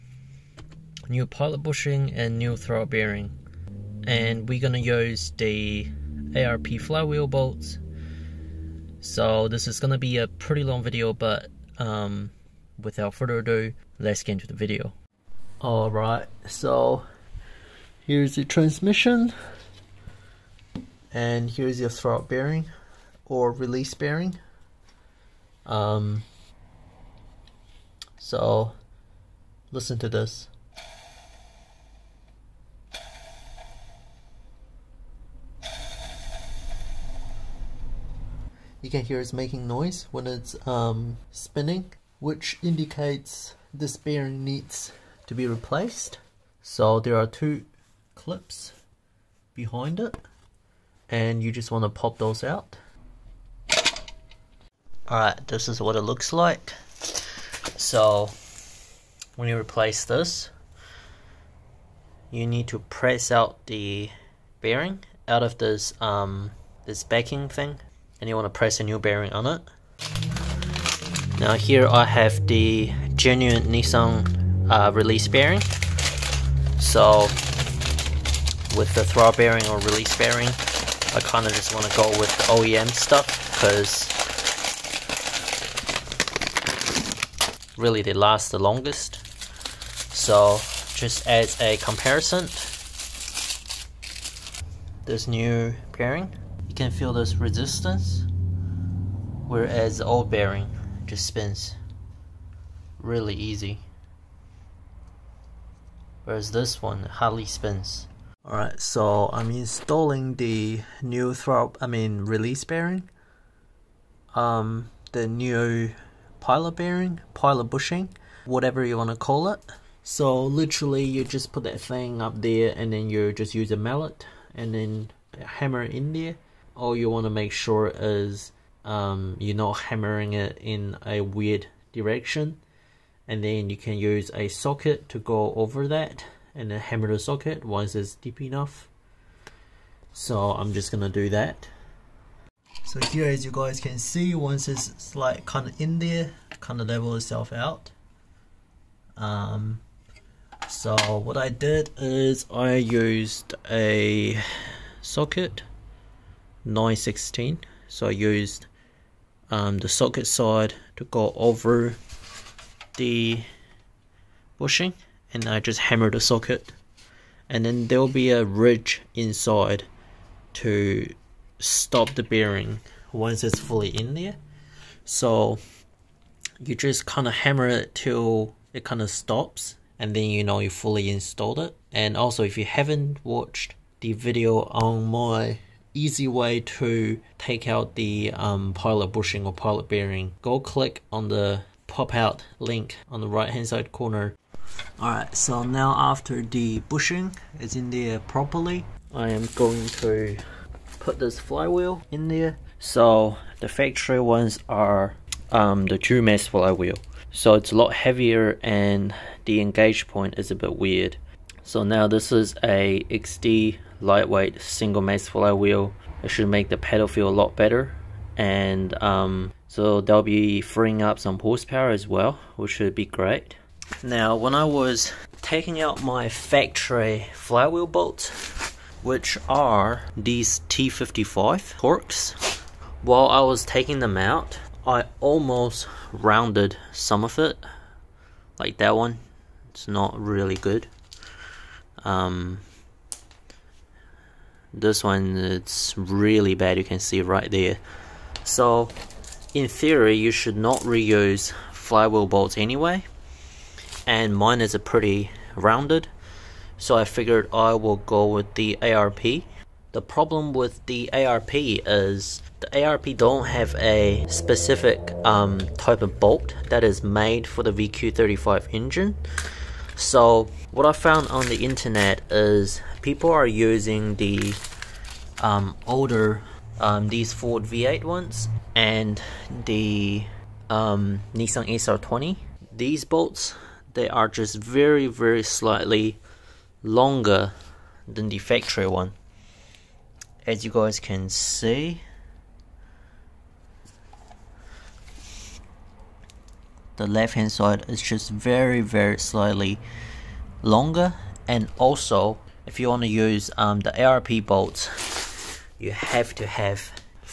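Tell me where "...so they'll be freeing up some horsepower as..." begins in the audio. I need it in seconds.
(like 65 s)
219 s.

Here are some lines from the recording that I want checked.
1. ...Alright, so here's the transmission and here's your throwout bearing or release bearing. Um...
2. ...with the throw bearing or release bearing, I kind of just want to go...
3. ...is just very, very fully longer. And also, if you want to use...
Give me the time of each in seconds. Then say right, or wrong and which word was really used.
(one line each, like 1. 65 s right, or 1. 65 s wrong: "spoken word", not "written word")
1. 15 s right
2. 78 s right
3. 297 s wrong: "slightly", not "fully".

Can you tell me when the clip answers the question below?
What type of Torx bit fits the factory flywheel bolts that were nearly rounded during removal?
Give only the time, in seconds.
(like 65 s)
230 s.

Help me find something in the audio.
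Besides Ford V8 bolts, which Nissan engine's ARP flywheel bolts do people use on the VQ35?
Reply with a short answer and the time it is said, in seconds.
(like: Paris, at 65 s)
SR20, at 281 s.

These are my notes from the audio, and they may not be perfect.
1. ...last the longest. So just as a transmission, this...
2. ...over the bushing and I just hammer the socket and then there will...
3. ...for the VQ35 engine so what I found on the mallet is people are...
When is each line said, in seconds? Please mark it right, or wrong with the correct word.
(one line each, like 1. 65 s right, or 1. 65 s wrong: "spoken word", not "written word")
1. 88 s wrong: "comparison", not "transmission"
2. 161 s right
3. 267 s wrong: "internet", not "mallet".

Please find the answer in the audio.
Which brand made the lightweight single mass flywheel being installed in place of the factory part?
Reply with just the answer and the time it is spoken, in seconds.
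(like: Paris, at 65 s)
Exedy, at 213 s.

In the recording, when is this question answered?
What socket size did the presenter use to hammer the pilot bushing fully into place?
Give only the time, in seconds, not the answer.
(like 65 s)
156 s.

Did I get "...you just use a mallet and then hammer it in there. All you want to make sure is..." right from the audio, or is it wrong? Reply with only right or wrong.
right.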